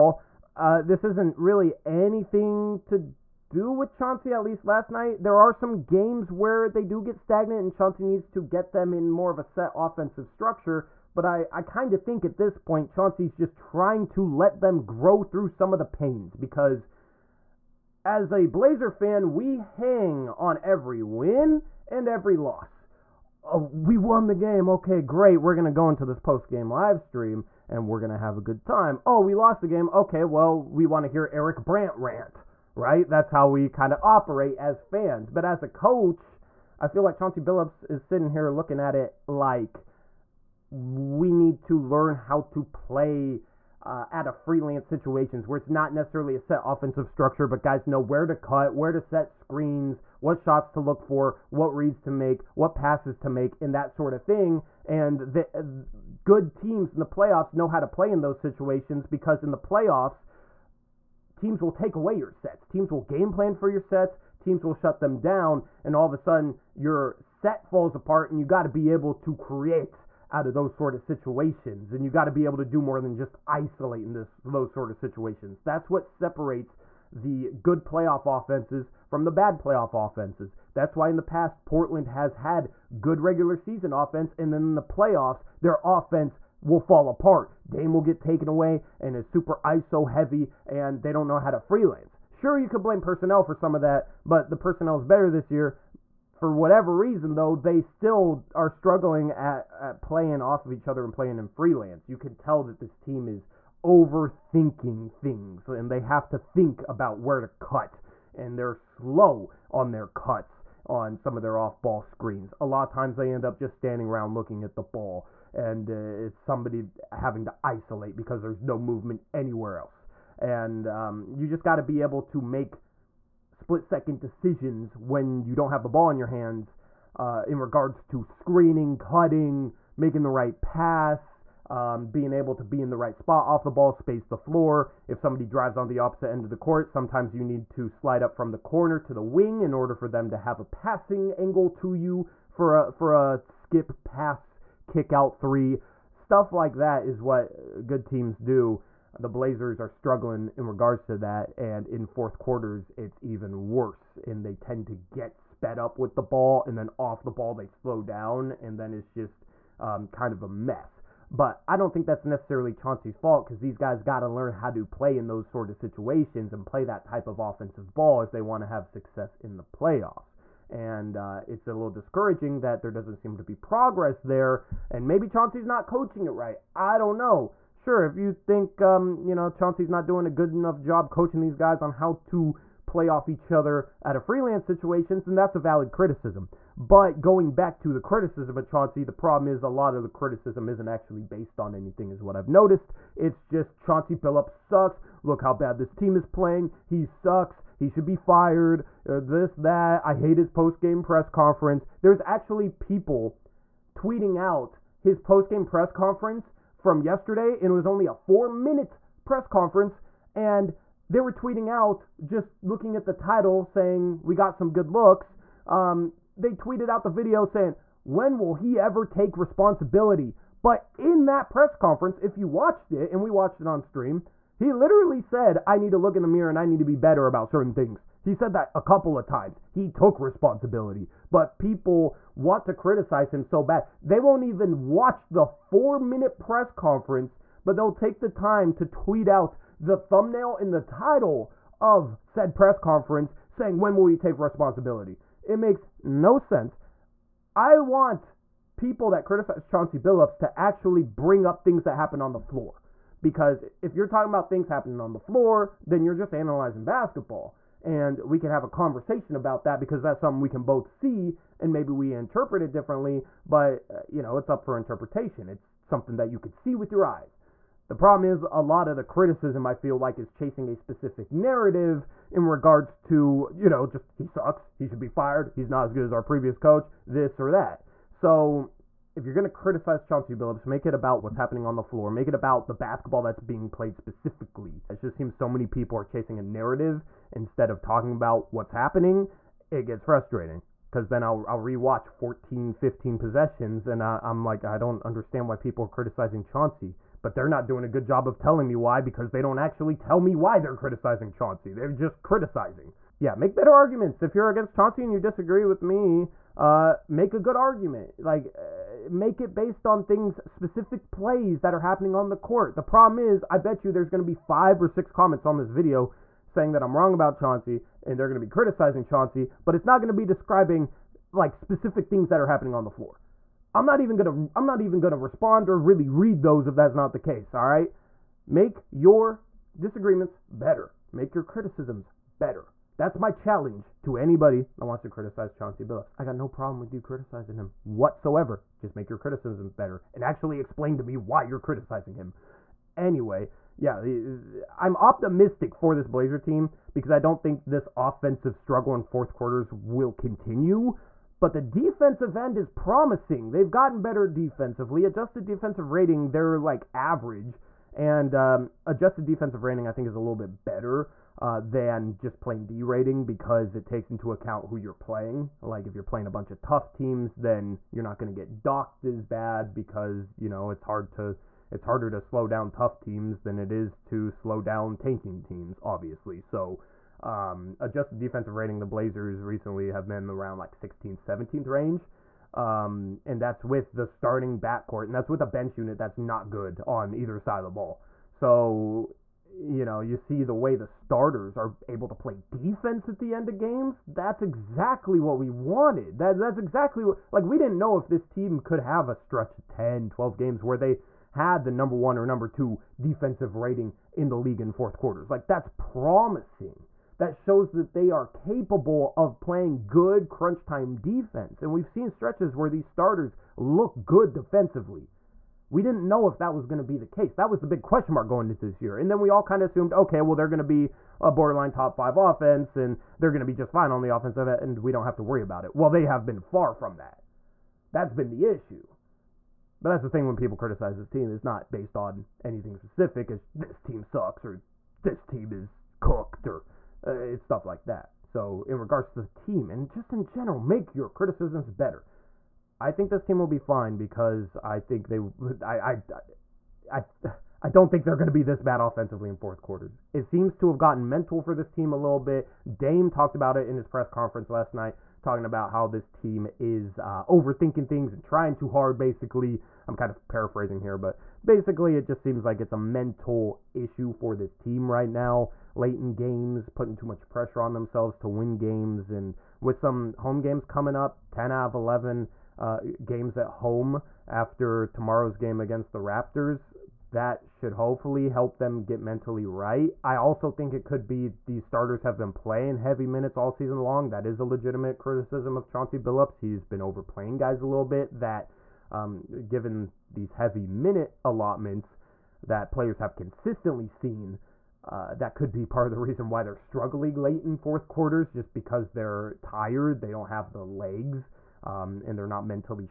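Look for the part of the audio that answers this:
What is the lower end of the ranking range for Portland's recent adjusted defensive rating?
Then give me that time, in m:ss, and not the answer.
6:20.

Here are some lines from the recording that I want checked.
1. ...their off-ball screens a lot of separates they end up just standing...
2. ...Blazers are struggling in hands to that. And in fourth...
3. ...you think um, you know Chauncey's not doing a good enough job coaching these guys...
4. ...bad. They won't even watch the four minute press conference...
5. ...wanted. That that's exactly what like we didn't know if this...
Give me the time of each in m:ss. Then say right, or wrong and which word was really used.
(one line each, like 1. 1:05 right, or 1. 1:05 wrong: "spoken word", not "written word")
1. 1:51 wrong: "times", not "separates"
2. 2:29 wrong: "regards", not "hands"
3. 2:58 right
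4. 3:53 right
5. 6:35 right.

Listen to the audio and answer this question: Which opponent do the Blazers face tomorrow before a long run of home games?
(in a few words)
Raptors.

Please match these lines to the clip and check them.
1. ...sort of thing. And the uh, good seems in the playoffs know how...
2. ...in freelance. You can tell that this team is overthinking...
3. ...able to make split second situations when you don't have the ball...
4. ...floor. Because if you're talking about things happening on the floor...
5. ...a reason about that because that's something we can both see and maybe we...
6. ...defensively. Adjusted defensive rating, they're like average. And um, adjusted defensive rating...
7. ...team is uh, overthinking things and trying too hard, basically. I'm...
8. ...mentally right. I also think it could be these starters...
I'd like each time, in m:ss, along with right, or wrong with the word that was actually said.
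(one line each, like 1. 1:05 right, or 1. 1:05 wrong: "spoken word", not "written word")
1. 0:53 wrong: "teams", not "seems"
2. 1:41 right
3. 2:02 wrong: "decisions", not "situations"
4. 4:12 right
5. 4:18 wrong: "conversation", not "reason"
6. 5:54 right
7. 7:36 right
8. 7:59 right.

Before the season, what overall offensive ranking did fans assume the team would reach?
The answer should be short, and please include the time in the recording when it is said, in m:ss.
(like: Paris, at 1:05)
top 5, at 7:01.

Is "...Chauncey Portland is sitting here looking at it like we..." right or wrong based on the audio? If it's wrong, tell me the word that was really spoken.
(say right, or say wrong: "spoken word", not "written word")
wrong: "Billups", not "Portland".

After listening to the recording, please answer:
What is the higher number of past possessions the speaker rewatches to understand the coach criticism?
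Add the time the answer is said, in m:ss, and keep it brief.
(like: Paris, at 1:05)
15, at 4:52.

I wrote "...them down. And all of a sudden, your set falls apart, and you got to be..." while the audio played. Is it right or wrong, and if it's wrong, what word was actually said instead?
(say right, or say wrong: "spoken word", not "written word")
right.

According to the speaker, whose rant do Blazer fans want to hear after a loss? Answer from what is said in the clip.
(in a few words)
Eric Brant.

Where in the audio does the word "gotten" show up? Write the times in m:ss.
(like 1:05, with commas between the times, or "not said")
5:53, 7:30.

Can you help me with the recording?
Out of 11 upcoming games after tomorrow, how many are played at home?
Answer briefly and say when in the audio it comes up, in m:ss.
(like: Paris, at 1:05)
10, at 7:51.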